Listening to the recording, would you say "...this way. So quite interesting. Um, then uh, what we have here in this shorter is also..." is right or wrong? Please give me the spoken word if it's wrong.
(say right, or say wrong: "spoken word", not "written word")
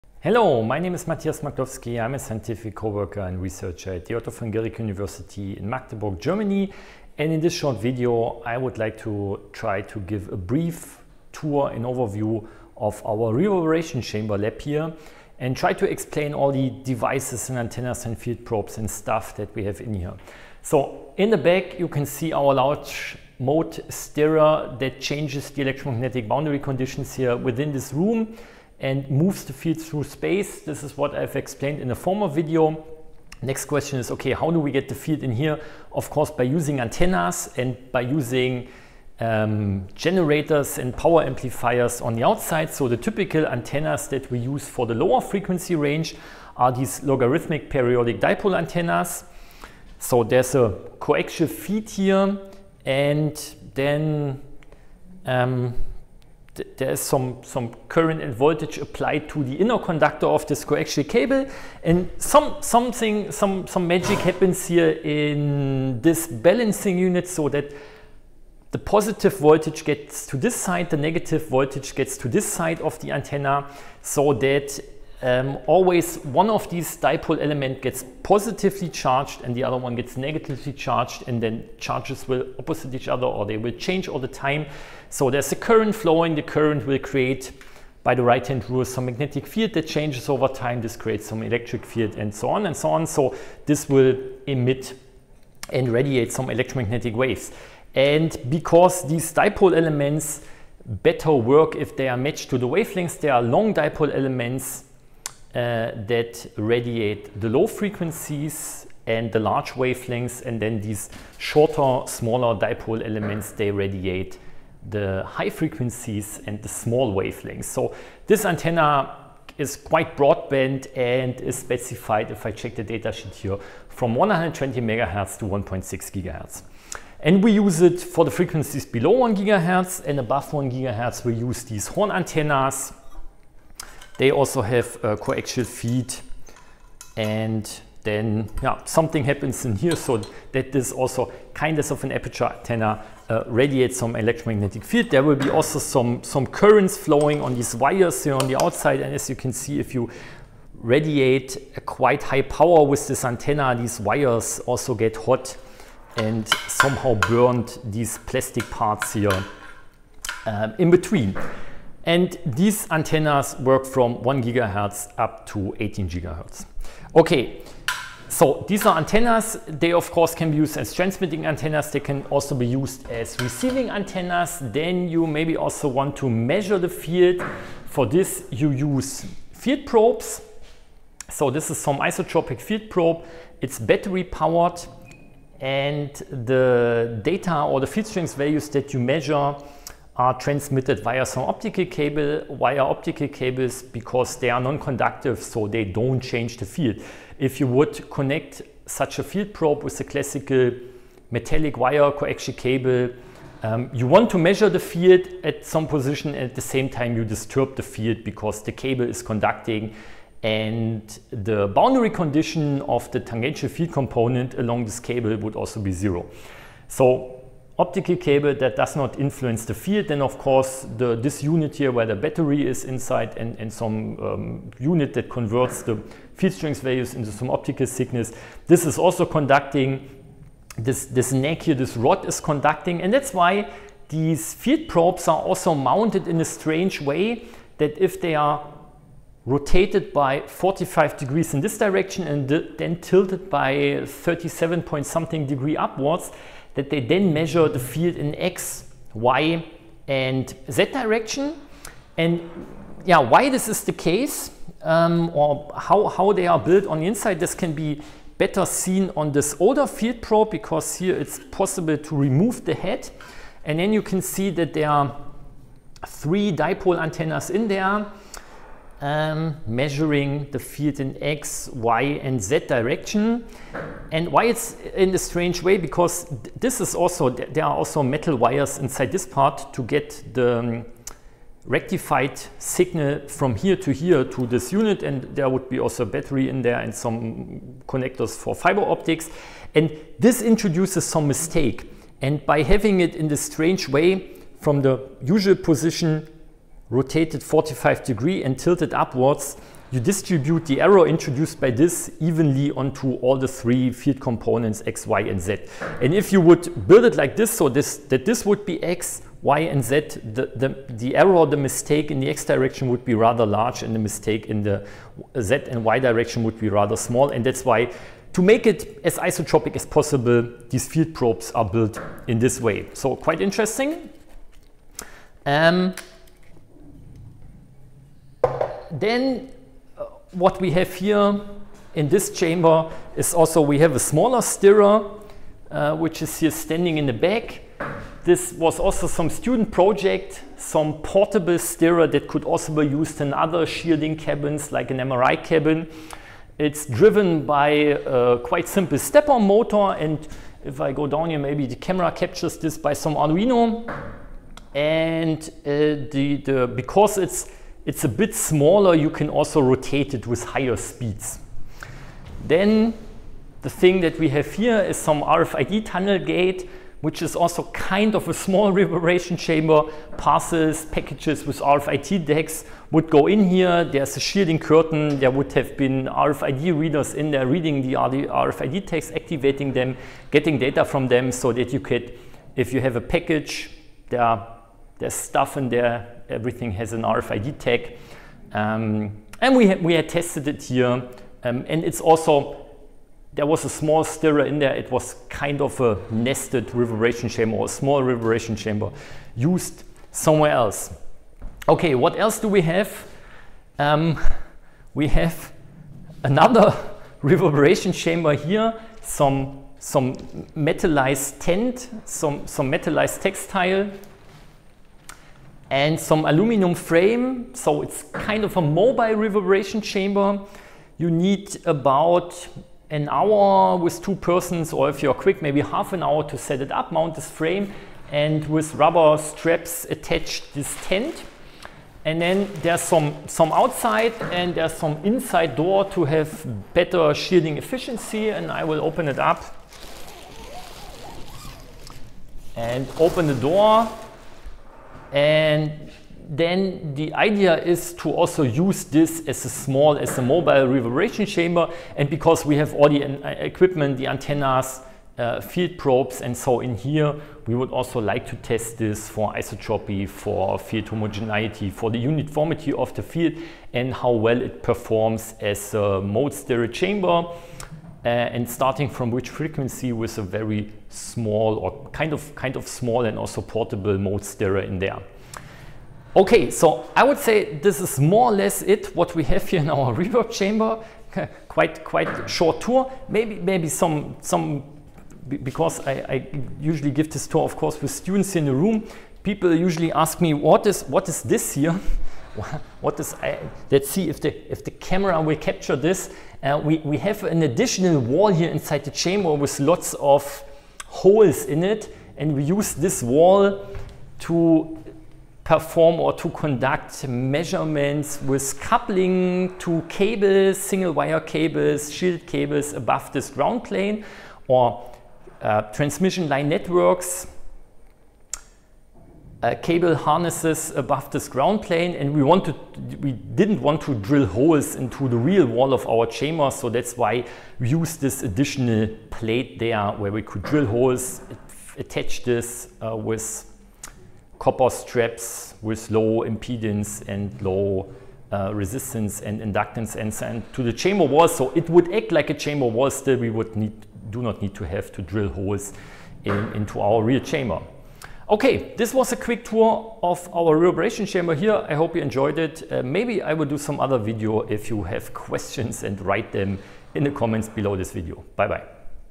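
wrong: "chamber", not "shorter".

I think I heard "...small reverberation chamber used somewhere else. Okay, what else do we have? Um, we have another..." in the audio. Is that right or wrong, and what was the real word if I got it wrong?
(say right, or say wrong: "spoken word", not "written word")
right.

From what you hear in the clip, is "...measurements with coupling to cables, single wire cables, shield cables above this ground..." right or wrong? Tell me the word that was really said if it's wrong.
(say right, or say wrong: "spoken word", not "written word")
right.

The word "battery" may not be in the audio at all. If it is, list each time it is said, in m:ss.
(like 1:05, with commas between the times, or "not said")
3:03, 3:42, 4:46.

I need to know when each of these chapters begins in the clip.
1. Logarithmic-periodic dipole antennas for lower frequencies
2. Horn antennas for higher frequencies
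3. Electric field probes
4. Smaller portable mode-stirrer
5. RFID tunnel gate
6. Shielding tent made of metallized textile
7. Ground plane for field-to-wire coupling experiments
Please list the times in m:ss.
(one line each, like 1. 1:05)
1. 0:42
2. 2:10
3. 2:54
4. 5:28
5. 6:03
6. 6:41
7. 8:01.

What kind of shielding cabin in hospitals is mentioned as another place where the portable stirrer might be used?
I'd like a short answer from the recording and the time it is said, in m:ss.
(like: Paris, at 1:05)
MRI cabin, at 5:44.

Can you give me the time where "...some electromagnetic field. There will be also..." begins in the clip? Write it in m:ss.
2:23.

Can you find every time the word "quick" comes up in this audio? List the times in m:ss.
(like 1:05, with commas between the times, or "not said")
7:05, 9:09.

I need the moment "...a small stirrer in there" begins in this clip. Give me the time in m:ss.
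6:33.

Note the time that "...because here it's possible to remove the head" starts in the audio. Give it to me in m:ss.
4:20.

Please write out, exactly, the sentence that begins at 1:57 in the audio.
So this antenna is quite broadband and is specified, if I check the datasheet here, from 120 megahertz to 1.6 gigahertz.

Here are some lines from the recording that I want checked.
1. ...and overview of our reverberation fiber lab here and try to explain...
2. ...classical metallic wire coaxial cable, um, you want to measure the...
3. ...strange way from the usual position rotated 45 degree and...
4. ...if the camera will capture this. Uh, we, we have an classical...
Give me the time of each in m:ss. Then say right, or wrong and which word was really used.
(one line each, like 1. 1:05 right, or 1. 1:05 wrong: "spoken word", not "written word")
1. 0:11 wrong: "chamber", not "fiber"
2. 3:20 right
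3. 4:53 right
4. 8:14 wrong: "additional", not "classical".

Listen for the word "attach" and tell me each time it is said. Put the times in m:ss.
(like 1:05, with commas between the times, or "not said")
7:09, 8:51.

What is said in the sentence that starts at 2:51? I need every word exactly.
They can also be used as receiving antennas.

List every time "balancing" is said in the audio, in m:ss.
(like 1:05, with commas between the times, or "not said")
1:06.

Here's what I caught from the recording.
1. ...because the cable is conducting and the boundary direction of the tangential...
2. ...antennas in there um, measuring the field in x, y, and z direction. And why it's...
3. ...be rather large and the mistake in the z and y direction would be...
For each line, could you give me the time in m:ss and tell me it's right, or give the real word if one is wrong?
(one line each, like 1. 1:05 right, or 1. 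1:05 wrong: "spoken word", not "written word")
1. 3:28 wrong: "condition", not "direction"
2. 4:27 right
3. 5:13 right.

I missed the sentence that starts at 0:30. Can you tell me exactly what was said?
This is what I've explained in a former video.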